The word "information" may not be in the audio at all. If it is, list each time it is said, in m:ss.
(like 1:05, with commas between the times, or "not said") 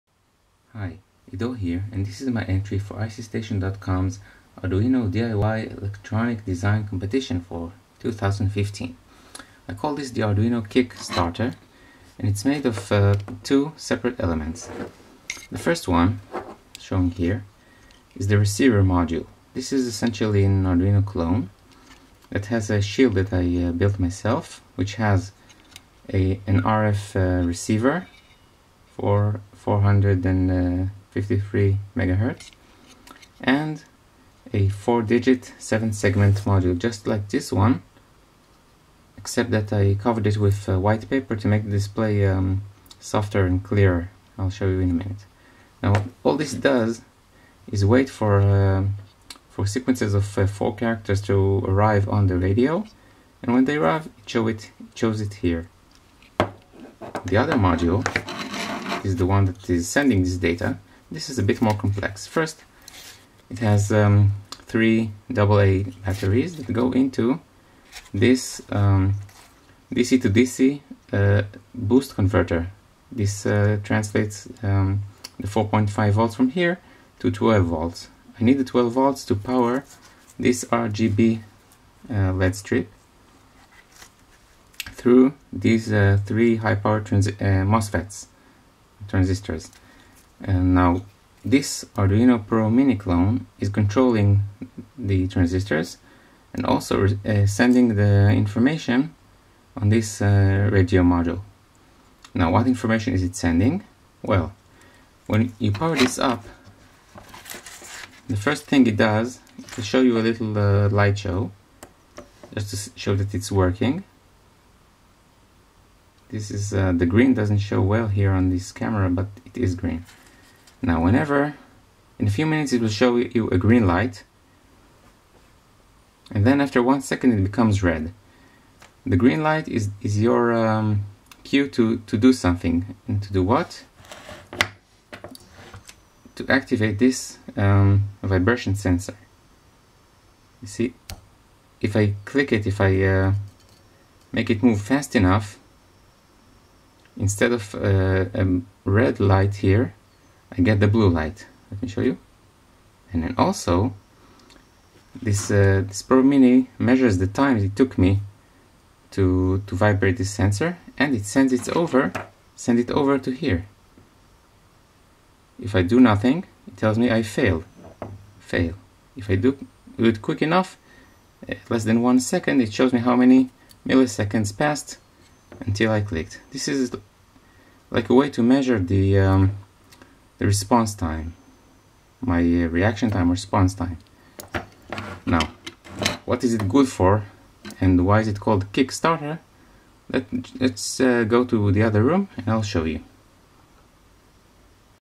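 1:38, 1:42.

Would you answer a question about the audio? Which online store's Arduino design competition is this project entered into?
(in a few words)
ICStation.com.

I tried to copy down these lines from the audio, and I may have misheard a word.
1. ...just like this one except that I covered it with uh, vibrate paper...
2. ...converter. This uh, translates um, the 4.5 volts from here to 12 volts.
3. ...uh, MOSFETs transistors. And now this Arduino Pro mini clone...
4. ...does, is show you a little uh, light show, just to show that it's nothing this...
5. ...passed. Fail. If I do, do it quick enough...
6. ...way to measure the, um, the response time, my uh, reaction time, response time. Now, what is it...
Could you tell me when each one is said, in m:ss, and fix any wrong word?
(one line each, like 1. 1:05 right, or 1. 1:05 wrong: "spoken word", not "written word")
1. 0:36 wrong: "white", not "vibrate"
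2. 1:12 right
3. 1:26 right
4. 1:49 wrong: "working", not "nothing"
5. 2:47 wrong: "failed", not "passed"
6. 2:58 right.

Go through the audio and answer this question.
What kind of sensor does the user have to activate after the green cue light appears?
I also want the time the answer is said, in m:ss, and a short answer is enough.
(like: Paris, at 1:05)
vibration sensor, at 2:18.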